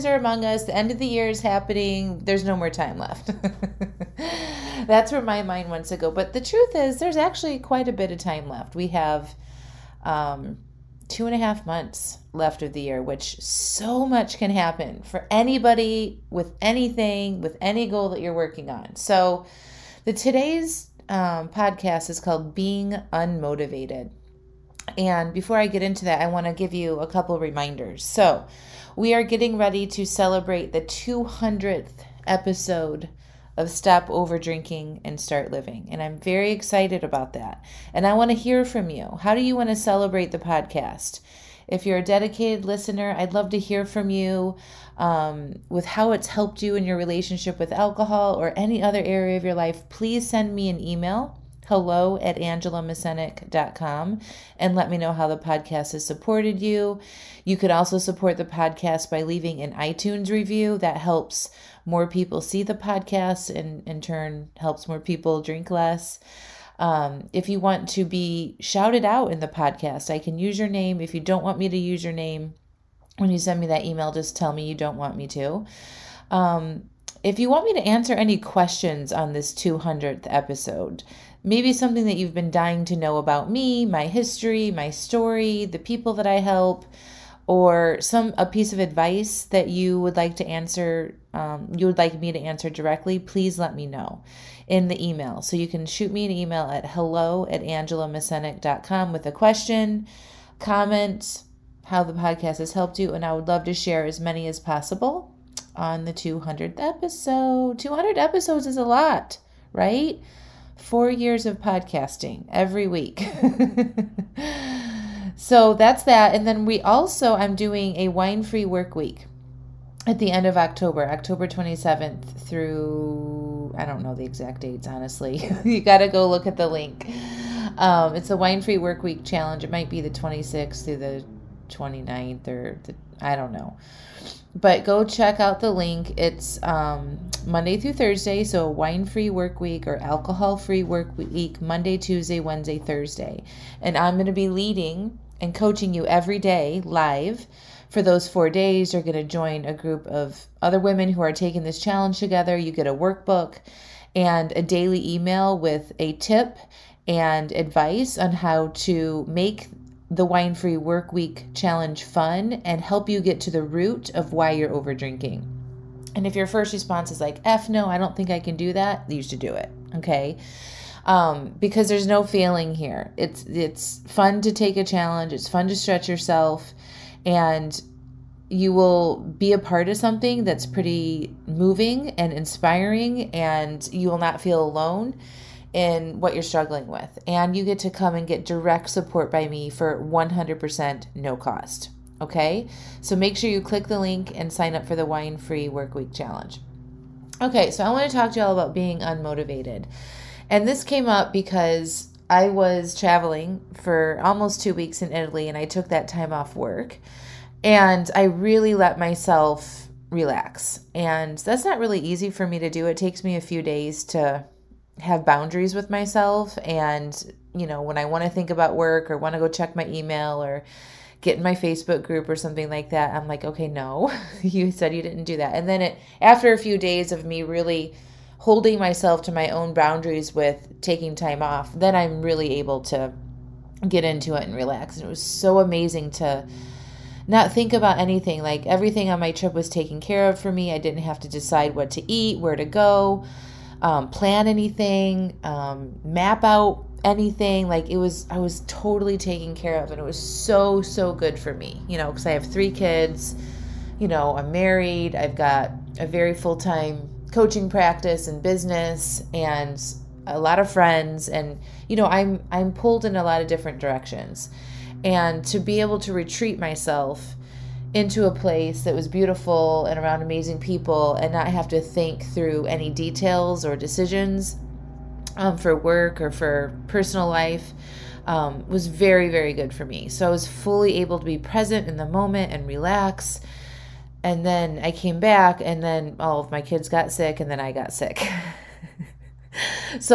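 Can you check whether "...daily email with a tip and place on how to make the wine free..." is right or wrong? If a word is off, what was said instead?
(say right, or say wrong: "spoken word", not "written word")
wrong: "advice", not "place".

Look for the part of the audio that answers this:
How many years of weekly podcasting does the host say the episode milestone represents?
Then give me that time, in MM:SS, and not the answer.
01:50.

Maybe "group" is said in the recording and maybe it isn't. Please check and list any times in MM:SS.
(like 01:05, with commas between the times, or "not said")
02:29, 03:42.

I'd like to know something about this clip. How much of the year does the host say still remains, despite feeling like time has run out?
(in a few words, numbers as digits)
2.5 months.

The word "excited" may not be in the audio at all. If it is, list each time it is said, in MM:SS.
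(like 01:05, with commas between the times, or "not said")
00:36.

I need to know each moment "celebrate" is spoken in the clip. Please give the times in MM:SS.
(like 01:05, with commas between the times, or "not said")
00:30, 00:39.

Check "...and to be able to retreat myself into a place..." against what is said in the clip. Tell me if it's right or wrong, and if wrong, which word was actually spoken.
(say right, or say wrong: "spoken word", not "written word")
right.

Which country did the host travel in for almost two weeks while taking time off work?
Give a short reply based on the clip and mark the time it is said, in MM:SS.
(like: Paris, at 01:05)
Italy, at 03:25.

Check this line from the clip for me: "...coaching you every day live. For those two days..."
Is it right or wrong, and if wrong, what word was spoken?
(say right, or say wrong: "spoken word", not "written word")
wrong: "four", not "two".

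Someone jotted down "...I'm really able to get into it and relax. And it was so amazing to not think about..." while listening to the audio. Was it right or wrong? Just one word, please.
right.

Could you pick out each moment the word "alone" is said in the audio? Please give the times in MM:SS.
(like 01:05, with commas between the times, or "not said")
03:04.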